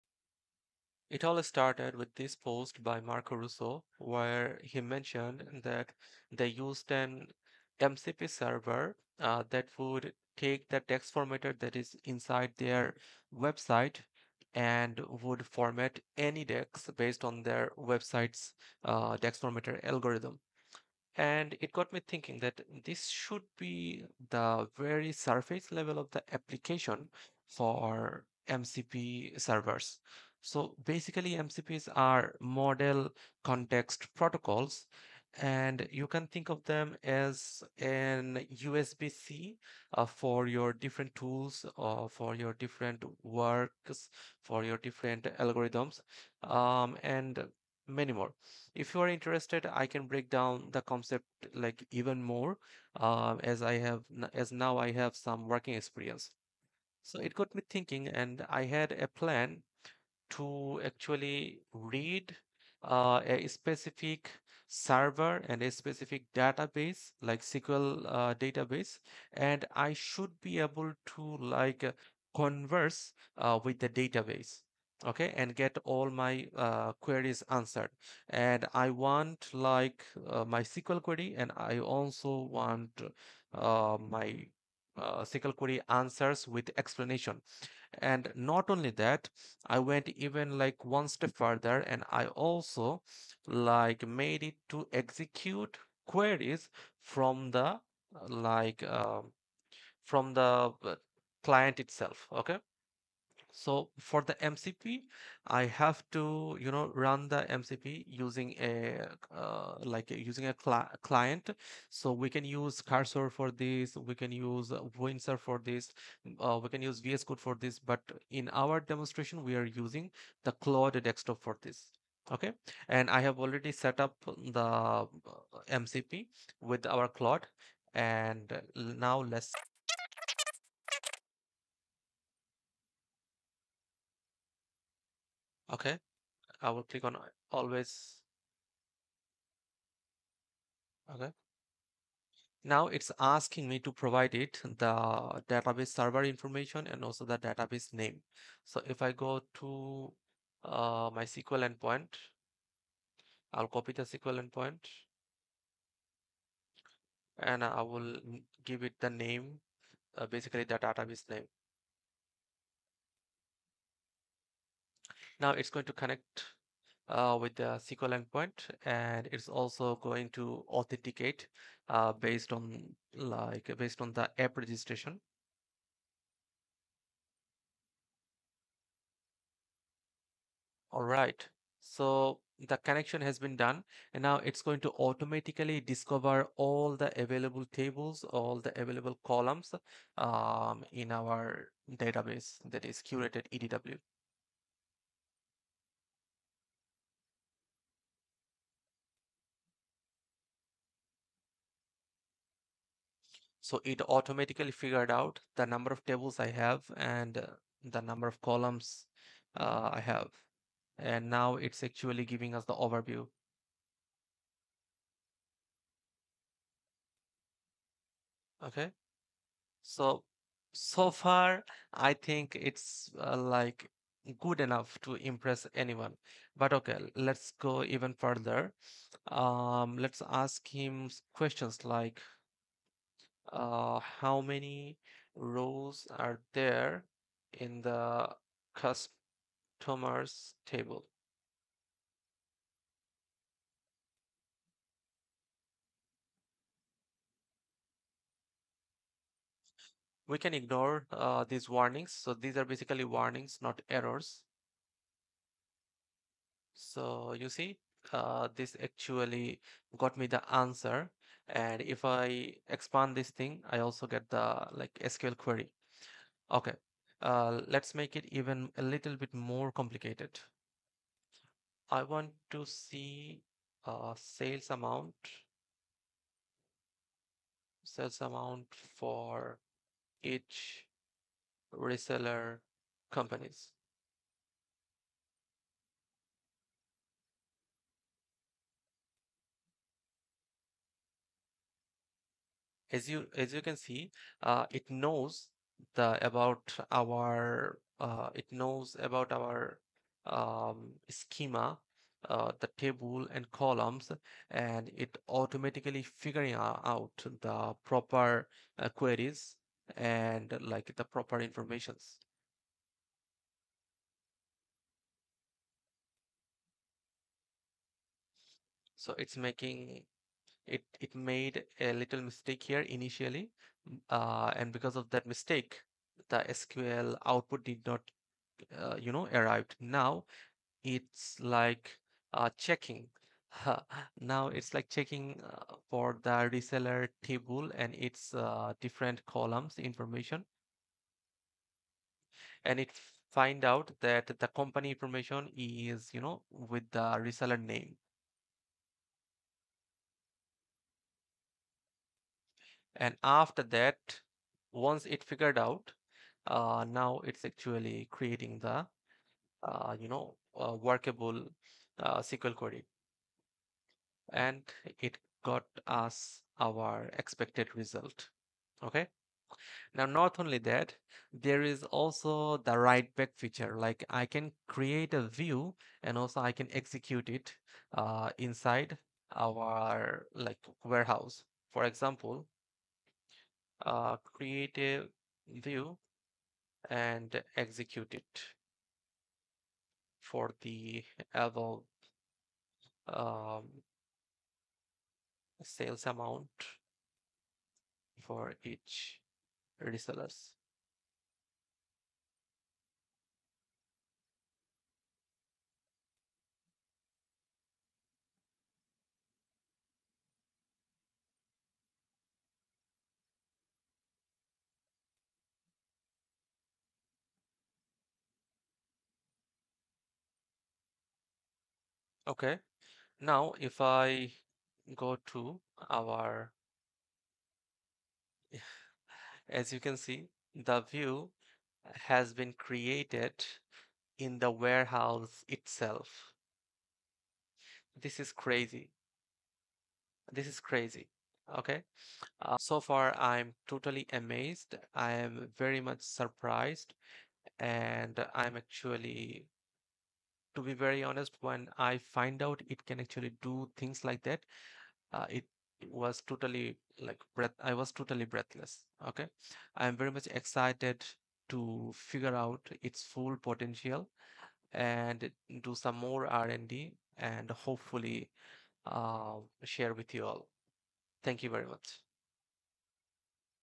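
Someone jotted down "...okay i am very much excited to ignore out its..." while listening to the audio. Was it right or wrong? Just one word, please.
wrong.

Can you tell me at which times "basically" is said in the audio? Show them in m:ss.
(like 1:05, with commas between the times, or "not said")
0:30, 2:40, 4:12.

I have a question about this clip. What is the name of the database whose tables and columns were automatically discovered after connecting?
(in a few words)
curated EDW.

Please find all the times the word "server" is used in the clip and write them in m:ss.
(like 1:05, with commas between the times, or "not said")
0:08, 0:29, 1:04, 2:25.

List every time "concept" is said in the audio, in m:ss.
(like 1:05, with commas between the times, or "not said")
0:50.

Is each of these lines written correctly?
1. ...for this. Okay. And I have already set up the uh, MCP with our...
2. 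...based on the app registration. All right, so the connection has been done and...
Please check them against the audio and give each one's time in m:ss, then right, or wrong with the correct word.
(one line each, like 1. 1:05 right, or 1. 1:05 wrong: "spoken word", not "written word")
1. 2:01 right
2. 2:53 right.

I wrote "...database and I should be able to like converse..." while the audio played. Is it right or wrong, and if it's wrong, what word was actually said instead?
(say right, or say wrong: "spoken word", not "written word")
right.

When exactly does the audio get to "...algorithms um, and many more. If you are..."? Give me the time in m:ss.
0:45.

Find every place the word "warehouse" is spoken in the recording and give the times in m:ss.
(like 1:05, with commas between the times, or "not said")
6:20, 7:14.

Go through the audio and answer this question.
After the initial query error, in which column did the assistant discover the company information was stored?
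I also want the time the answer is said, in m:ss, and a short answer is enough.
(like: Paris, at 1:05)
reseller name, at 5:47.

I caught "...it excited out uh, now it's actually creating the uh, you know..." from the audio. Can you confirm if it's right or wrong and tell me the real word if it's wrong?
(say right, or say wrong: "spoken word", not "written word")
wrong: "figured", not "excited".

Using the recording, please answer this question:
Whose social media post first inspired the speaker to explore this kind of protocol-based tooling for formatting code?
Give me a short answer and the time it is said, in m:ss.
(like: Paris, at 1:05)
Marco Russo, at 0:03.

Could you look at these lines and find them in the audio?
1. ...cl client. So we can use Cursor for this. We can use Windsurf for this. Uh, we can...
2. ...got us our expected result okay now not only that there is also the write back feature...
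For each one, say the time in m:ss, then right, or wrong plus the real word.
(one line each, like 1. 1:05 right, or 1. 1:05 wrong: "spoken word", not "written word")
1. 1:50 right
2. 6:05 right.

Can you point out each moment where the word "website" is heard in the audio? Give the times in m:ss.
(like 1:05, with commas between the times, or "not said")
0:13, 0:17.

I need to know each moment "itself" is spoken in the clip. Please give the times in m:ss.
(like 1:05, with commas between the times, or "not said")
1:41, 7:15.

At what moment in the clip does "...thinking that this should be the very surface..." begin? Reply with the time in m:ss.
0:22.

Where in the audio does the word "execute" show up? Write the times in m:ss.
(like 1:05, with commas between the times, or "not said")
1:34, 6:16, 6:27.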